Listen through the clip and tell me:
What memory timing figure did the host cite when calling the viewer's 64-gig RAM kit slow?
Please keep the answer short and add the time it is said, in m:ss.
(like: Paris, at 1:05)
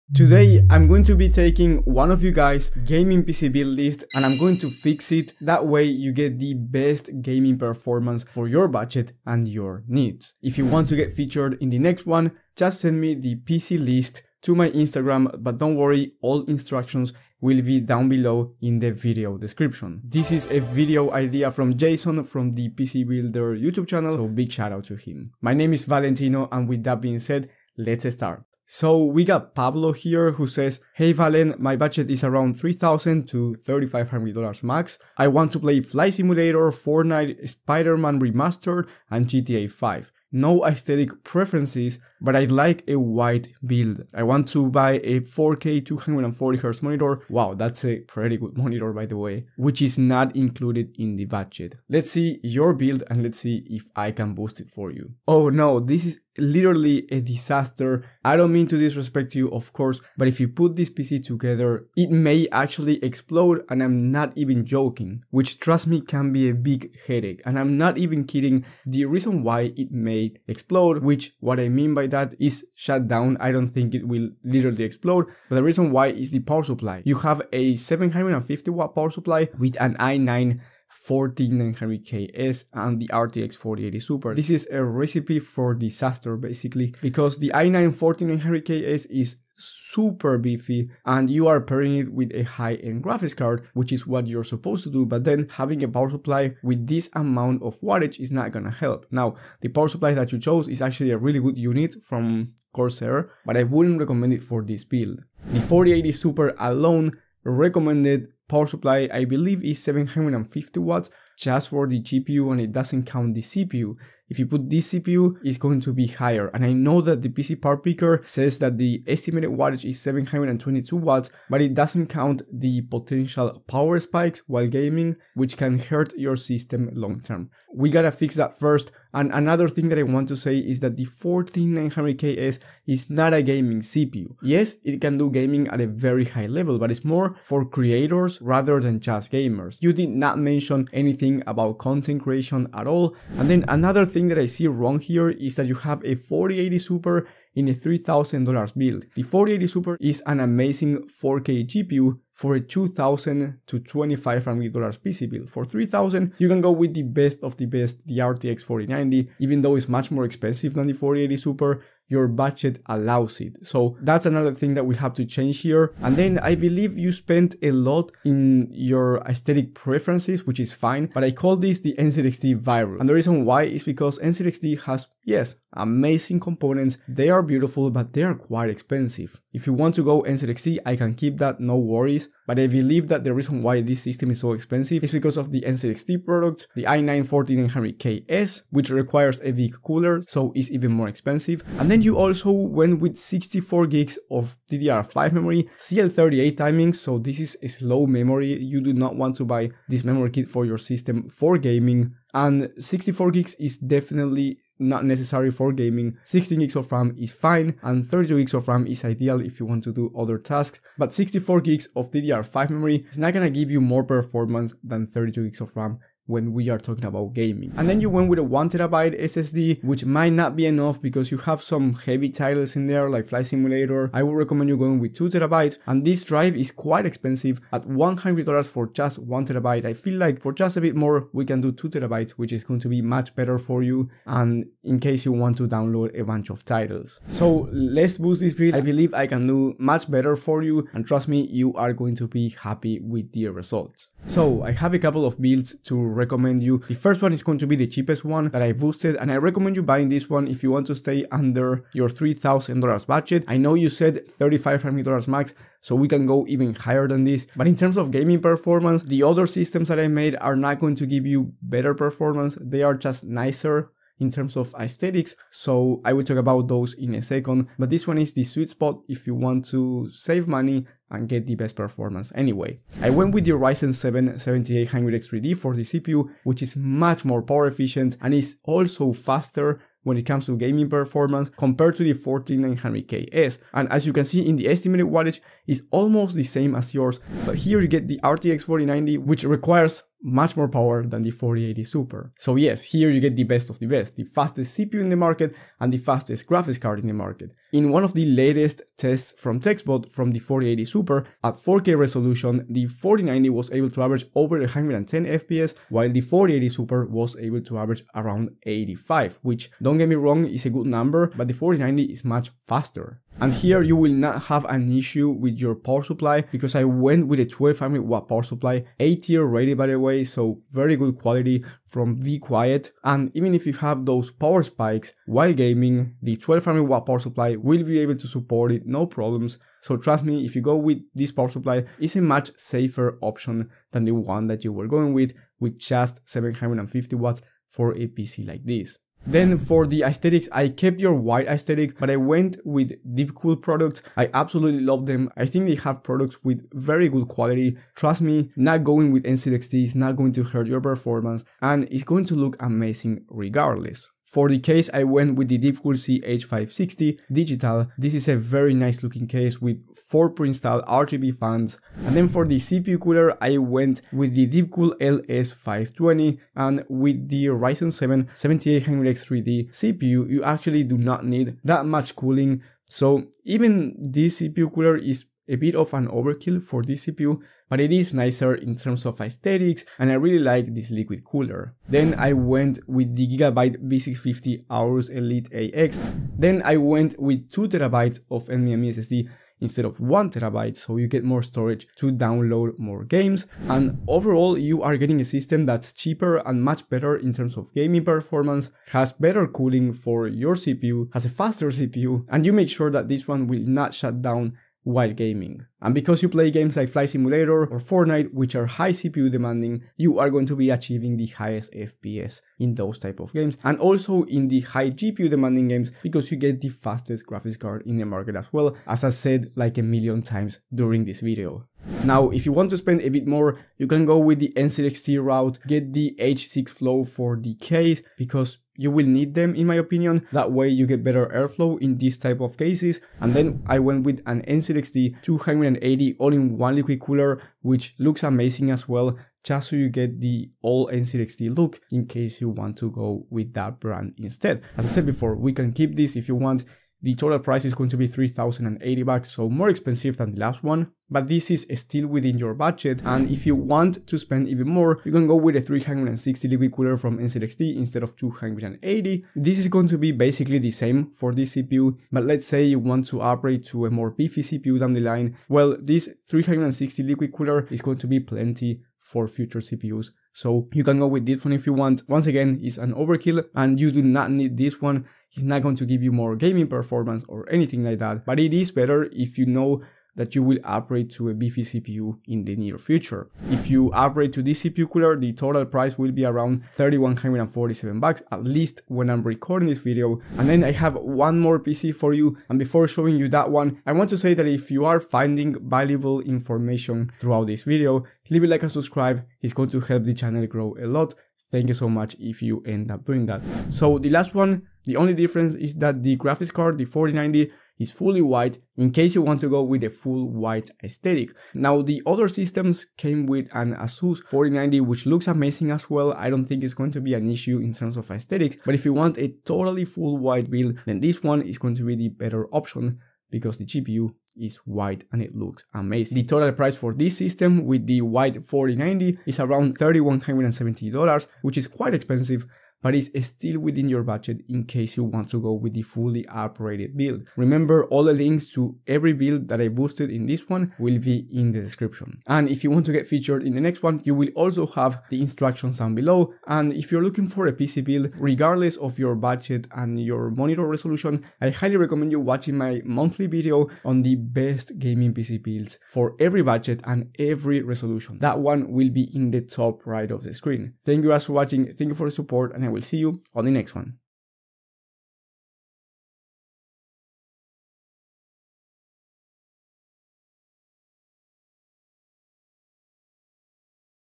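CL38, at 3:15.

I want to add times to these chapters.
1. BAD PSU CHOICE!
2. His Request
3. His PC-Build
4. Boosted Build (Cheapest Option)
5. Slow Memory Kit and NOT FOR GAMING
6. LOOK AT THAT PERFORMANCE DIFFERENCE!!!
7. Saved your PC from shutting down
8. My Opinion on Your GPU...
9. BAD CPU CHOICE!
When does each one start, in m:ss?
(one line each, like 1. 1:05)
1. 1:35
2. 0:30
3. 0:52
4. 4:07
5. 3:12
6. 5:00
7. 5:14
8. 2:29
9. 2:09.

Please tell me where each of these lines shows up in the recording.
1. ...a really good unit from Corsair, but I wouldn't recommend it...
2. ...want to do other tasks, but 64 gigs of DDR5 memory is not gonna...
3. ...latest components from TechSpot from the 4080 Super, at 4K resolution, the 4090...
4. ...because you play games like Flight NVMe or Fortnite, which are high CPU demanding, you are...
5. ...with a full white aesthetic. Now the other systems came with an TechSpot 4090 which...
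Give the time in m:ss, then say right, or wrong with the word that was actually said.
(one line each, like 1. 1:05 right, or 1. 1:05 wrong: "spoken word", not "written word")
1. 1:41 right
2. 3:29 right
3. 4:58 wrong: "tests", not "components"
4. 6:45 wrong: "Simulator", not "NVMe"
5. 8:29 wrong: "Asus", not "TechSpot".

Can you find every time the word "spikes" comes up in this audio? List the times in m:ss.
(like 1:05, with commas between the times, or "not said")
2:03, 5:24.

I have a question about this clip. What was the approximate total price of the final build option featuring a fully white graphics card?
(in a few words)
$3170.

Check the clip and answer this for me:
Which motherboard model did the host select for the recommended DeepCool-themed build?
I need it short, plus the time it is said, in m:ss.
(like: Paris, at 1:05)
Gigabyte B650 Aorus Elite AX, at 6:23.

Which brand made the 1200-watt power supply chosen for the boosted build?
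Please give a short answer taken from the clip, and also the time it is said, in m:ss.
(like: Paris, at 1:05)
be quiet, at 5:22.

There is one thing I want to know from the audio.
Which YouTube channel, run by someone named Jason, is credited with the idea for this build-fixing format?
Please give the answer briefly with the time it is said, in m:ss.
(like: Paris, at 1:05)
PC Builder, at 0:22.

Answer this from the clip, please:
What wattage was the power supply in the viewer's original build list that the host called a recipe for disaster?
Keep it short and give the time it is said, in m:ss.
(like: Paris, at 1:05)
750 watt, at 1:17.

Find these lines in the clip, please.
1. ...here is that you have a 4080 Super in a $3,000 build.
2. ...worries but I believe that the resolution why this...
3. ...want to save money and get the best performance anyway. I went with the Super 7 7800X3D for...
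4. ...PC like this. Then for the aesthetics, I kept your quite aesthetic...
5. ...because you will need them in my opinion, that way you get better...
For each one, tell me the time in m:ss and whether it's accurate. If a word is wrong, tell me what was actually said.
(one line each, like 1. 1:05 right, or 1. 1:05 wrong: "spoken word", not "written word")
1. 2:24 right
2. 3:01 wrong: "reason", not "resolution"
3. 4:29 wrong: "Ryzen", not "Super"
4. 5:38 wrong: "white", not "quite"
5. 7:08 right.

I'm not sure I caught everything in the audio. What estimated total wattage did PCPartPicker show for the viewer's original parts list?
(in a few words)
722 watts.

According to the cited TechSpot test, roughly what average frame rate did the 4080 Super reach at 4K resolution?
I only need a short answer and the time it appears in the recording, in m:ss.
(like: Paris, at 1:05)
85, at 5:08.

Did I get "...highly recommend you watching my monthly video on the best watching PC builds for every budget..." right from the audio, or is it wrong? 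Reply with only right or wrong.
wrong.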